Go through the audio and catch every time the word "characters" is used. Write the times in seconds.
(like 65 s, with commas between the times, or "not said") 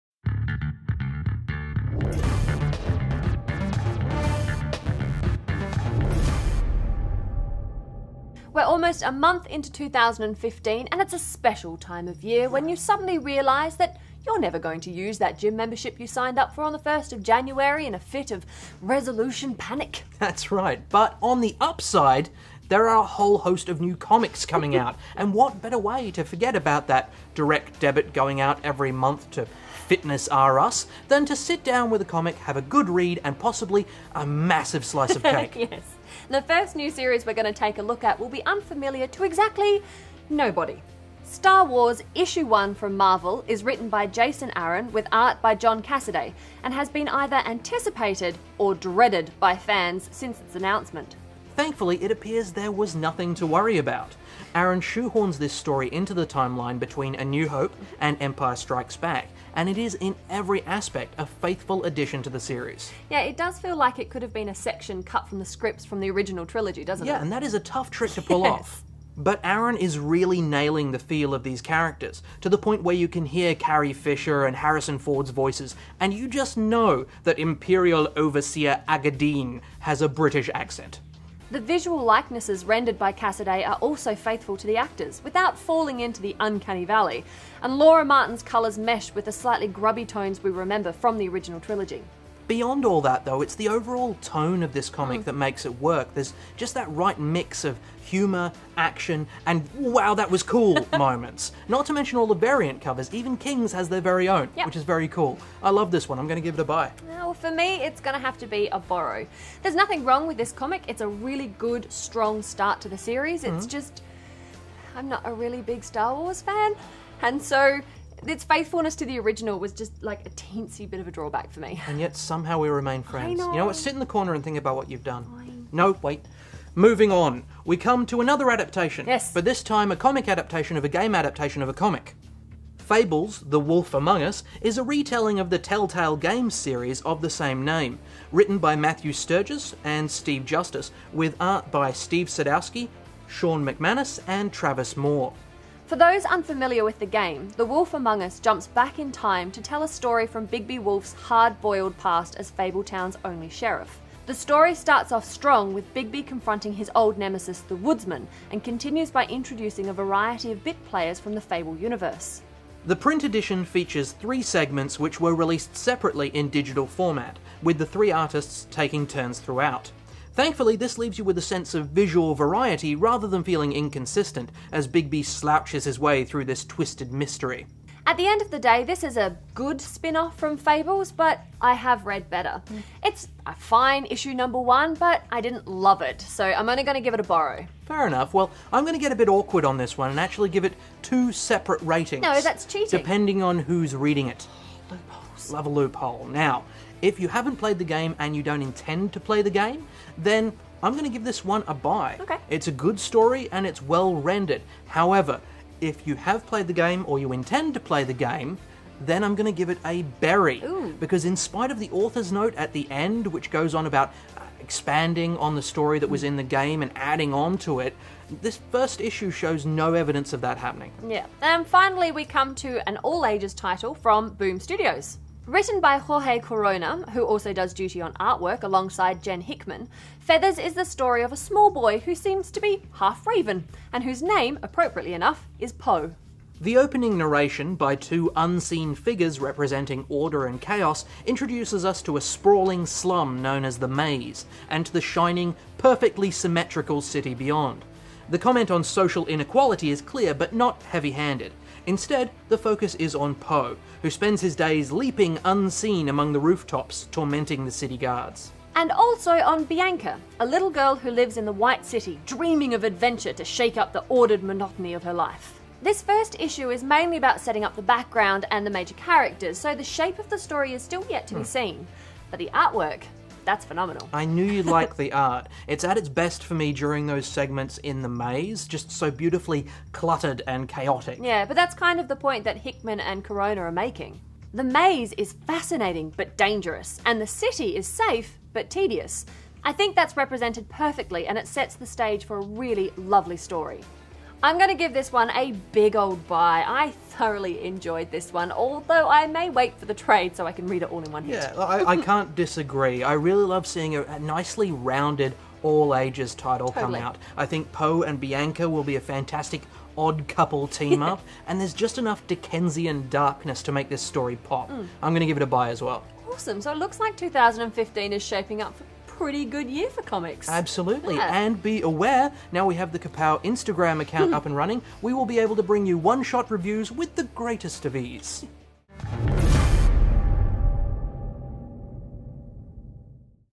71 s, 268 s.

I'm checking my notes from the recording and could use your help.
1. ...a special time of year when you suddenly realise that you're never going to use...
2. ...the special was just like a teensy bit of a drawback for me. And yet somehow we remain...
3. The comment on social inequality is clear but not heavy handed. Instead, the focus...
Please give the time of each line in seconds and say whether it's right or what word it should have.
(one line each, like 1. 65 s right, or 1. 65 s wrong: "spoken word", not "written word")
1. 11 s right
2. 119 s wrong: "original", not "special"
3. 248 s right.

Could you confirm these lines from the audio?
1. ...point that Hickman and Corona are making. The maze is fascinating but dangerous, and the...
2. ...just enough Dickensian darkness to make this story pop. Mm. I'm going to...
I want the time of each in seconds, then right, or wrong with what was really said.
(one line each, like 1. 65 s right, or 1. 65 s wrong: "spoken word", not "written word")
1. 282 s right
2. 311 s right.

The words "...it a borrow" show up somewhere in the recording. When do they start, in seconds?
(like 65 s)
187 s.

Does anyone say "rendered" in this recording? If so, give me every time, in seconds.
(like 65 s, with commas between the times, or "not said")
82 s, 204 s.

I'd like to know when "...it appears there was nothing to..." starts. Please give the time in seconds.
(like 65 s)
52 s.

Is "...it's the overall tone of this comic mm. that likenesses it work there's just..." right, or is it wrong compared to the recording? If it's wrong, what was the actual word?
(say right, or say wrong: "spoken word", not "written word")
wrong: "makes", not "likenesses".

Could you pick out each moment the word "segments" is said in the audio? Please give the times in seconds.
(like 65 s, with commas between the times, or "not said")
164 s, 277 s.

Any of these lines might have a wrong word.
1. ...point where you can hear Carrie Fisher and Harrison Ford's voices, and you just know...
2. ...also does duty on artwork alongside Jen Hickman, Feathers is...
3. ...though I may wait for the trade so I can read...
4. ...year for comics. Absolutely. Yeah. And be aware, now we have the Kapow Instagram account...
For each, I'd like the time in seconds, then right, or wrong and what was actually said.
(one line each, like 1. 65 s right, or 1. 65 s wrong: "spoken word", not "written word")
1. 72 s right
2. 227 s right
3. 298 s wrong: "although", not "though"
4. 319 s right.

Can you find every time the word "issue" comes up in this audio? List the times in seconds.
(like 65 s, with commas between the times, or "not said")
42 s, 184 s, 219 s, 266 s.